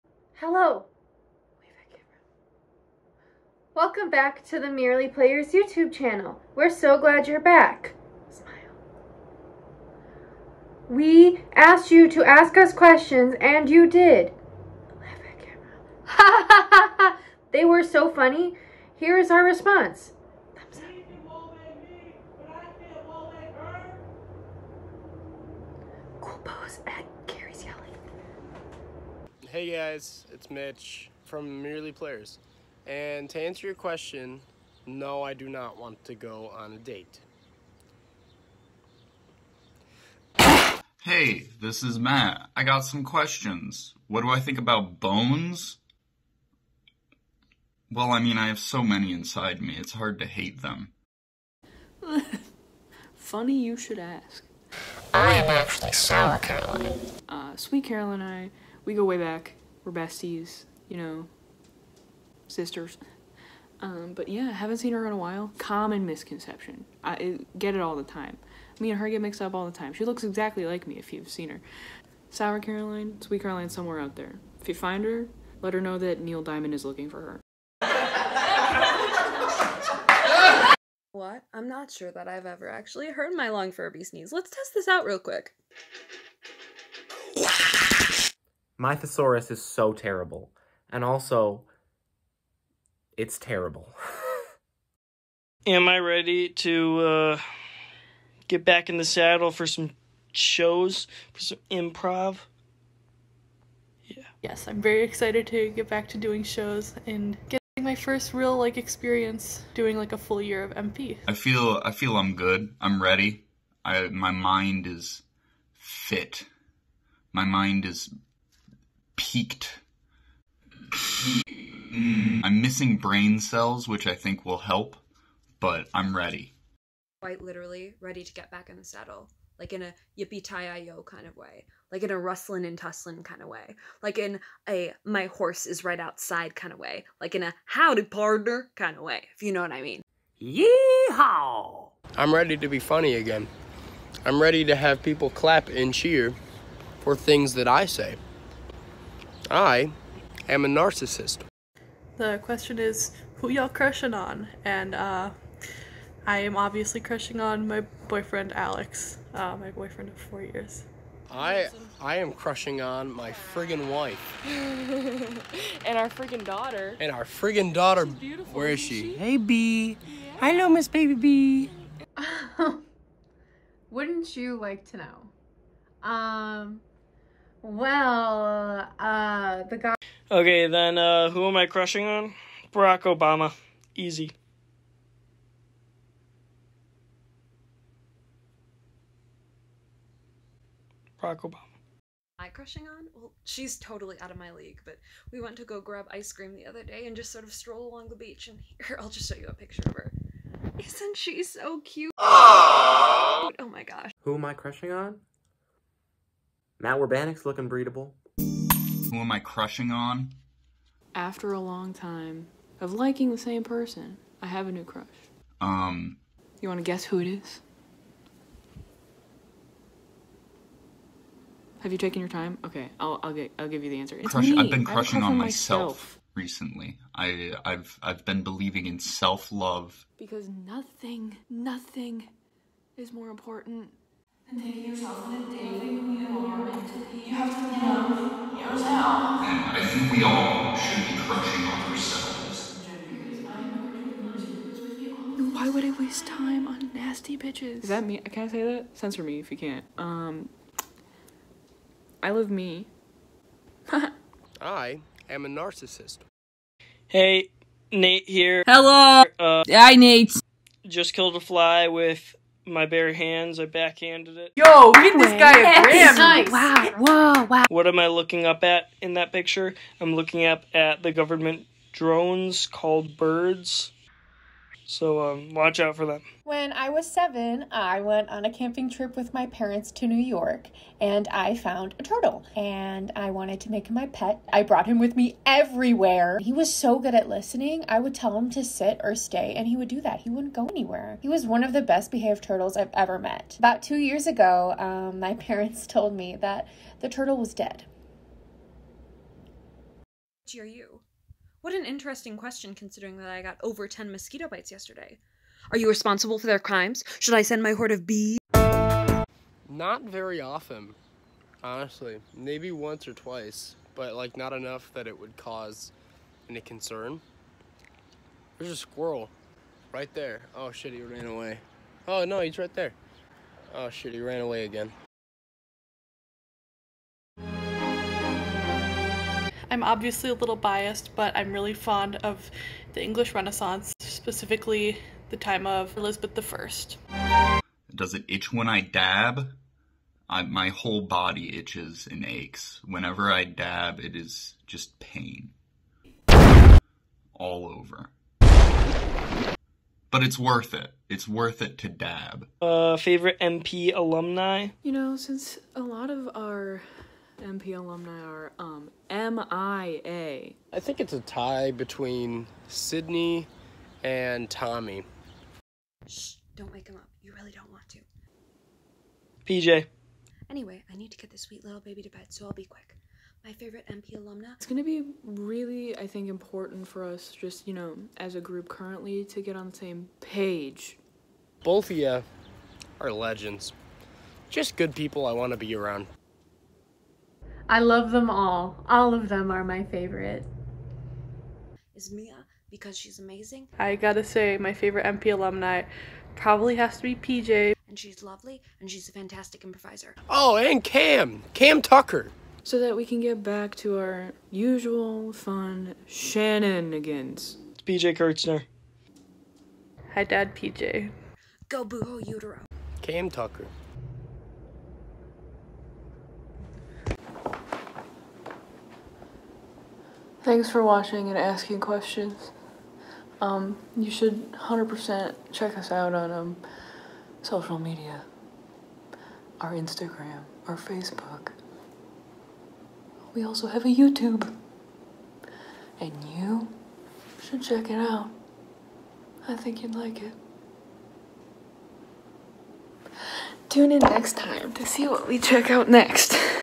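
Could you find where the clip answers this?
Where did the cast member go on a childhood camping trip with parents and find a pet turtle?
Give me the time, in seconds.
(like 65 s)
280 s.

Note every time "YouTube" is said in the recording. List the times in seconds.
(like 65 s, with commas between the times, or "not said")
5 s, 433 s.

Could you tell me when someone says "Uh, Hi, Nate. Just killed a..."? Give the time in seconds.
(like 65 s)
259 s.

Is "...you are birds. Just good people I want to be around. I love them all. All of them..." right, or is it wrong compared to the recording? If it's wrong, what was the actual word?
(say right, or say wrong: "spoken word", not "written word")
wrong: "legends", not "birds".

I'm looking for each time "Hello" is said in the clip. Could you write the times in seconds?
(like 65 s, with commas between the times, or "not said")
0 s, 170 s, 258 s.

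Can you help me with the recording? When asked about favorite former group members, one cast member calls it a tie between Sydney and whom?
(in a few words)
Tommy.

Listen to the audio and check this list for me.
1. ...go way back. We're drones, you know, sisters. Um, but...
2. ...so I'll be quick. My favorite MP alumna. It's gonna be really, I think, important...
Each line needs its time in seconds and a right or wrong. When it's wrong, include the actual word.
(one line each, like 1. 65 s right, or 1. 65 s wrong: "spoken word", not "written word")
1. 58 s wrong: "besties", not "drones"
2. 372 s right.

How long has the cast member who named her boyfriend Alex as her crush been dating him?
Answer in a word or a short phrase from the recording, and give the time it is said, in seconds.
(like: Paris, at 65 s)
4 years, at 160 s.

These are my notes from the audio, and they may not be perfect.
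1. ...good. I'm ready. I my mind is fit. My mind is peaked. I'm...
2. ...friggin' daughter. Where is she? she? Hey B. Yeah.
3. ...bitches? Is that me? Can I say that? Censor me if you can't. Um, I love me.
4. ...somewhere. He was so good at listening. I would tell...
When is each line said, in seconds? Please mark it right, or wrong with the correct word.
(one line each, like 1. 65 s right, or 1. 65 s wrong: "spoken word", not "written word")
1. 112 s right
2. 167 s right
3. 247 s right
4. 285 s wrong: "everywhere", not "somewhere".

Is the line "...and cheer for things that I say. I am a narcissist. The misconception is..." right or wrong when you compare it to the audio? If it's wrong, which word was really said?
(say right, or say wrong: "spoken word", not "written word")
wrong: "question", not "misconception".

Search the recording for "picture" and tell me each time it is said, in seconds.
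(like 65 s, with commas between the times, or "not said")
199 s, 269 s.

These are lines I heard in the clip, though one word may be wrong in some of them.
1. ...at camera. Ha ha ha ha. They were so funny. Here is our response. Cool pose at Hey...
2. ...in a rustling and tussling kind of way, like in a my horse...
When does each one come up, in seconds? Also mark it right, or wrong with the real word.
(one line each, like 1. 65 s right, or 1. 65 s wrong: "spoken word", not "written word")
1. 15 s right
2. 132 s right.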